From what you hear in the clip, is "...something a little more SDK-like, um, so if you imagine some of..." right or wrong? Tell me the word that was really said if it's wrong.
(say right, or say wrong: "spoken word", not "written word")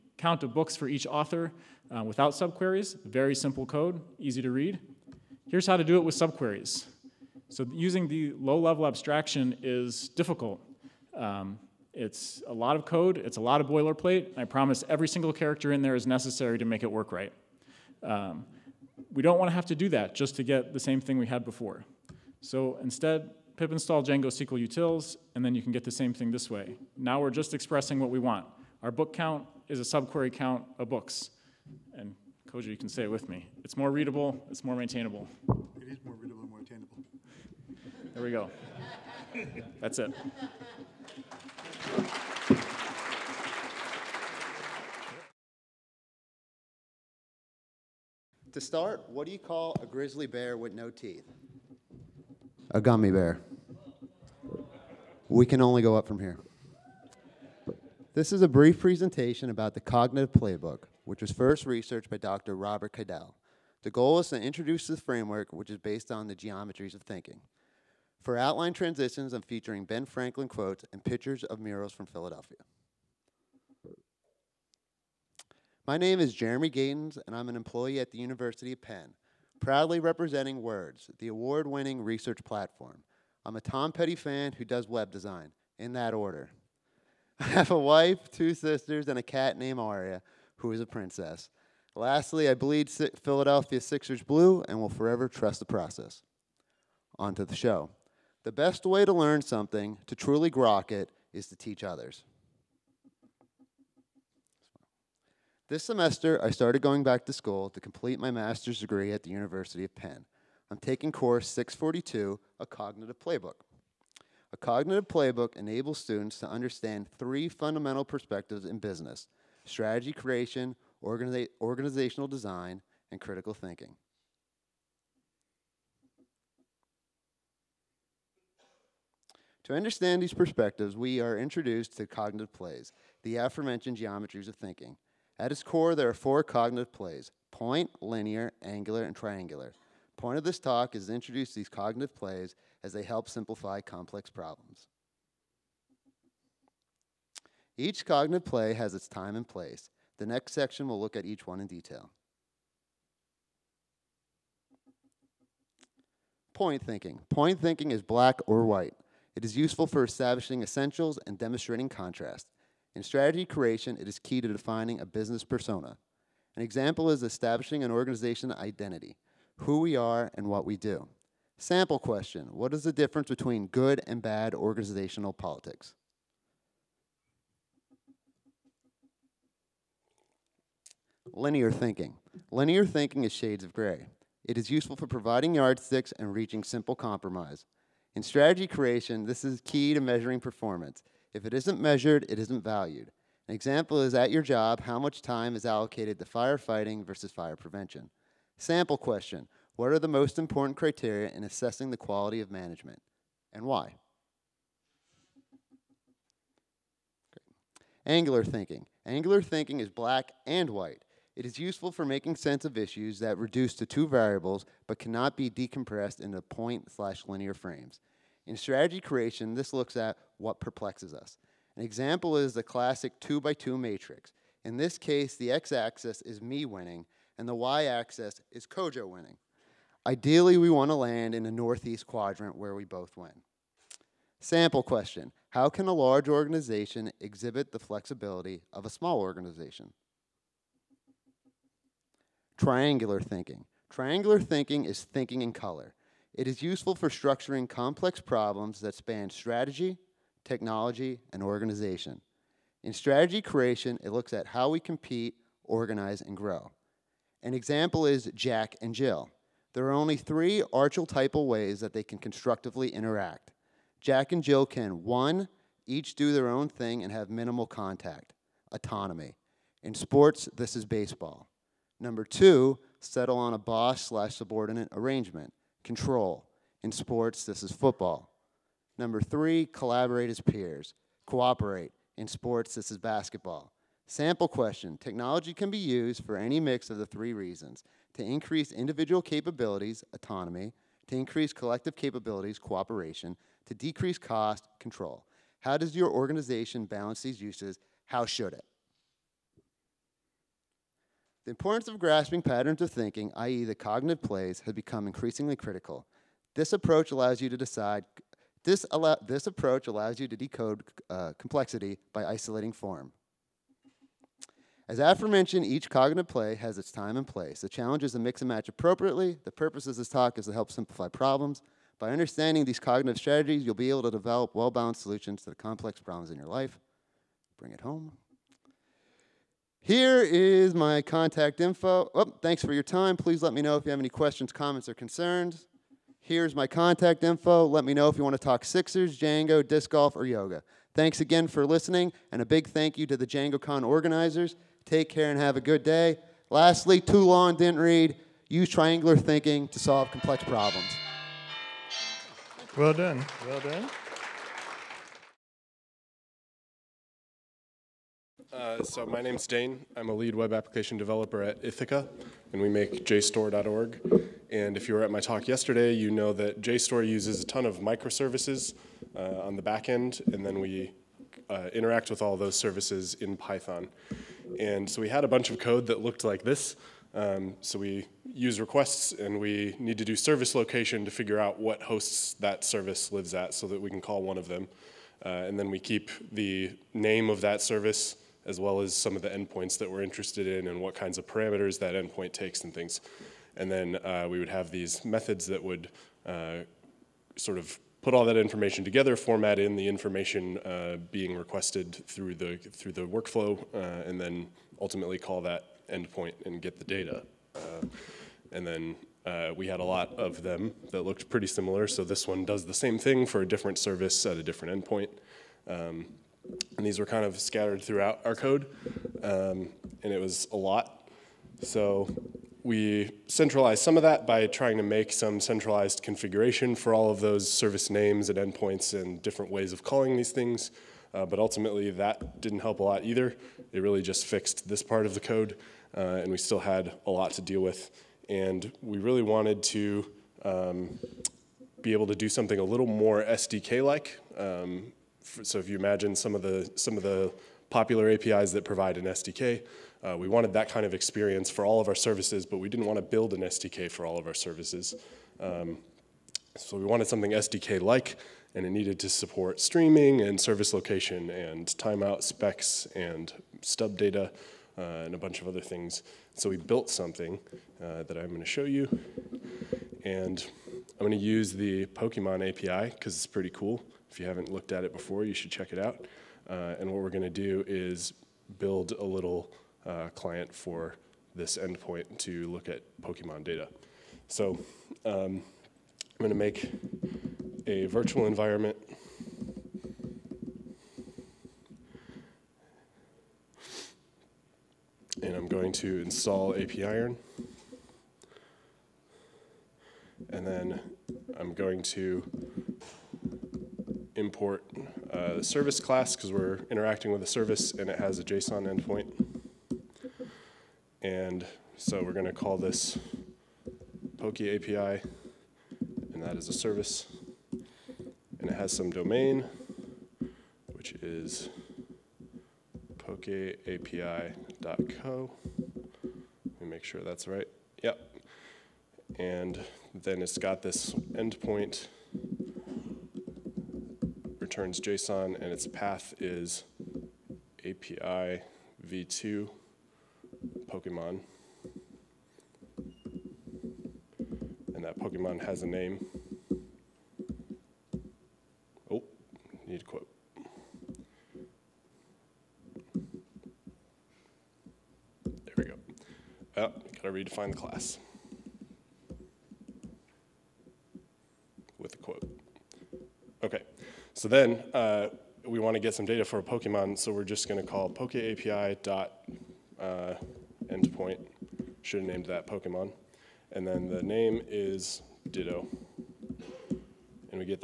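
right.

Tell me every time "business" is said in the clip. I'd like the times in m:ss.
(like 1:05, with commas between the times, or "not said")
1:58, 2:45.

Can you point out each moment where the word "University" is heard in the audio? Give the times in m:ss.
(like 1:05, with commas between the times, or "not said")
1:18, 1:49.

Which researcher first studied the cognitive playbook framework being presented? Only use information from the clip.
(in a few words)
Dr. Robert Keidel.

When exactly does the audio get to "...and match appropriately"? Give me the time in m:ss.
5:18.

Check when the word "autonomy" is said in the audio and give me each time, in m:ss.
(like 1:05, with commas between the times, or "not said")
4:28, 4:50.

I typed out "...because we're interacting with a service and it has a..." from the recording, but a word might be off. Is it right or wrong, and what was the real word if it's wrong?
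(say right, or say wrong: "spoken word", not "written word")
right.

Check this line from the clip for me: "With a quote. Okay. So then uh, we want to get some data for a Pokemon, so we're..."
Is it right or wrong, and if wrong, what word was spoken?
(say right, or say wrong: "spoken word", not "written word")
right.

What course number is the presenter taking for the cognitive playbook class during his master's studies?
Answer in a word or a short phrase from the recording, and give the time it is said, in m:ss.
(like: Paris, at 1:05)
642, at 1:51.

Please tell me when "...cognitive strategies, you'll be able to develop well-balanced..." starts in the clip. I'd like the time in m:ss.
5:22.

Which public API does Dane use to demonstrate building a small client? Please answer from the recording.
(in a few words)
The Pokemon API.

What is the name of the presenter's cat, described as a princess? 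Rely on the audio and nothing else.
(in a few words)
Aria.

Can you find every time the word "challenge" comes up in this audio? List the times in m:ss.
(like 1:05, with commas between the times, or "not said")
5:17.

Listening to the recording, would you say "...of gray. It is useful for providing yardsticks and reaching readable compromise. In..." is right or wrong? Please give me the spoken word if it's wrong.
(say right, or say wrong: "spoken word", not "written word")
wrong: "simple", not "readable".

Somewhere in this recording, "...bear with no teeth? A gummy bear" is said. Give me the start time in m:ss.
0:50.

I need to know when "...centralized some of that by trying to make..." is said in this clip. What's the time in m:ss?
7:03.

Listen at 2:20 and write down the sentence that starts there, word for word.
point of this talk is to introduce these cognitive plays as they help simplify complex problems.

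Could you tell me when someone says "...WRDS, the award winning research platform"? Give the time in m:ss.
1:20.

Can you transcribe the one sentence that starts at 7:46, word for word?
So we built something uh, that I'm going to show you.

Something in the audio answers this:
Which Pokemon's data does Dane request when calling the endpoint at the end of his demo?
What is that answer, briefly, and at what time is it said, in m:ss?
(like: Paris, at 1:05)
Ditto, at 9:35.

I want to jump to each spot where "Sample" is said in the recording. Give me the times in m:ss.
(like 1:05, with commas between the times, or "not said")
2:51, 3:18, 3:54, 4:44.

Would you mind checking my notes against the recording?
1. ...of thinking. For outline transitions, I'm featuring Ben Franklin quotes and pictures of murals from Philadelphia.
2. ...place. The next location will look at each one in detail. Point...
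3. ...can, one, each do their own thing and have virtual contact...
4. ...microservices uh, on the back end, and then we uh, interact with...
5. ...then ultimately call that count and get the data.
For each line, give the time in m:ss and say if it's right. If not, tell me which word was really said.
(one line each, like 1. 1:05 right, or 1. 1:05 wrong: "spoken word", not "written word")
1. 1:06 right
2. 2:29 wrong: "section", not "location"
3. 4:24 wrong: "minimal", not "virtual"
4. 6:07 right
5. 6:44 wrong: "endpoint", not "count".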